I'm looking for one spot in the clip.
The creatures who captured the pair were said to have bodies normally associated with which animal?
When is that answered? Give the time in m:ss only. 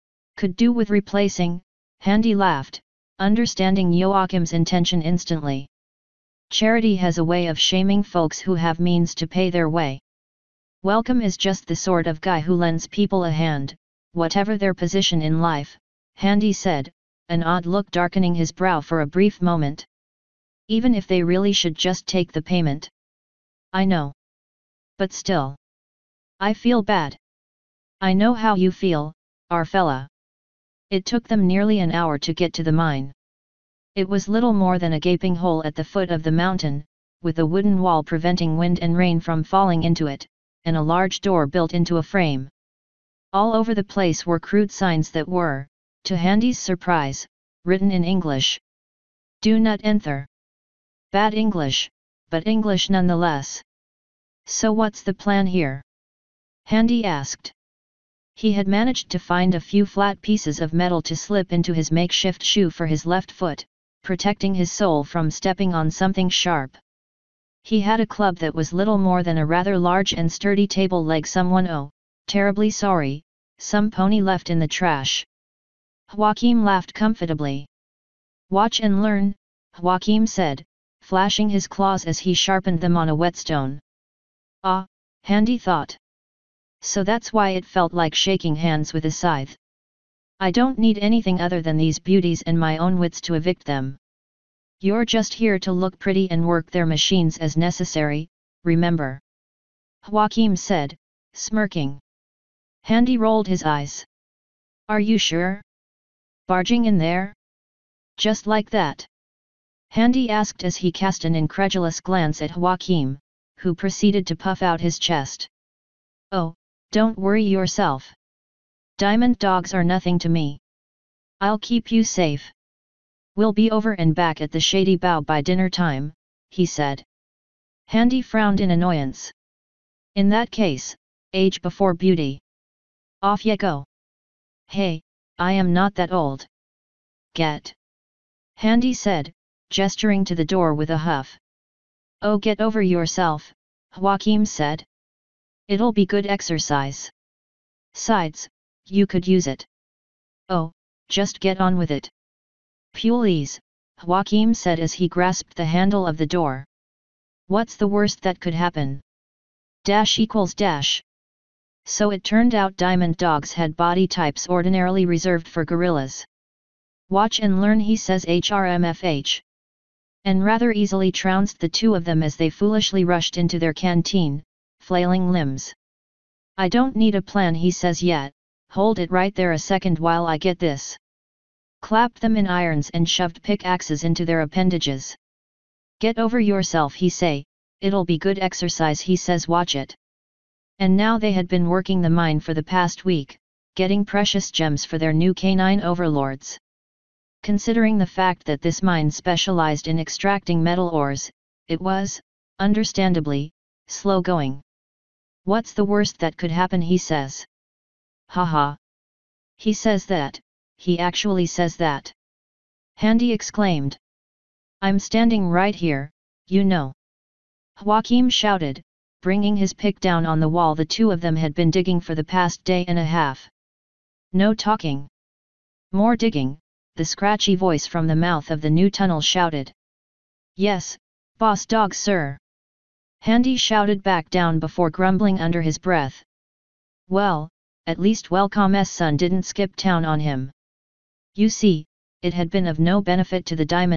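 2:45.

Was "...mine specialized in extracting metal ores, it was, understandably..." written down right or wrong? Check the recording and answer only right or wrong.
right.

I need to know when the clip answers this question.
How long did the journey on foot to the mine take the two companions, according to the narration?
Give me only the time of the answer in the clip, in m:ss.
0:31.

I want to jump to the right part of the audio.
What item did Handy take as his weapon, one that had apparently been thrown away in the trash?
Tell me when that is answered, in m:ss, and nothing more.
1:10.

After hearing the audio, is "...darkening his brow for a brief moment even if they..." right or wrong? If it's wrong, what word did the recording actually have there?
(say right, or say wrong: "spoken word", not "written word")
right.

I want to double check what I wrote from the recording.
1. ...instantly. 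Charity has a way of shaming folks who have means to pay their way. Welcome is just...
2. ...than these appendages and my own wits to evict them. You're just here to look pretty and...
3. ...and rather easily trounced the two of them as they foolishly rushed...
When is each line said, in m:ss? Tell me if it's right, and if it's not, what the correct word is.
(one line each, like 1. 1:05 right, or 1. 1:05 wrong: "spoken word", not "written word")
1. 0:05 right
2. 1:31 wrong: "beauties", not "appendages"
3. 2:50 right.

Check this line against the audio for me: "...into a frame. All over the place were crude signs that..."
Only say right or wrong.
right.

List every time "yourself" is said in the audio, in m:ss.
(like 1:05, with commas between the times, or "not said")
1:57, 2:22, 3:06.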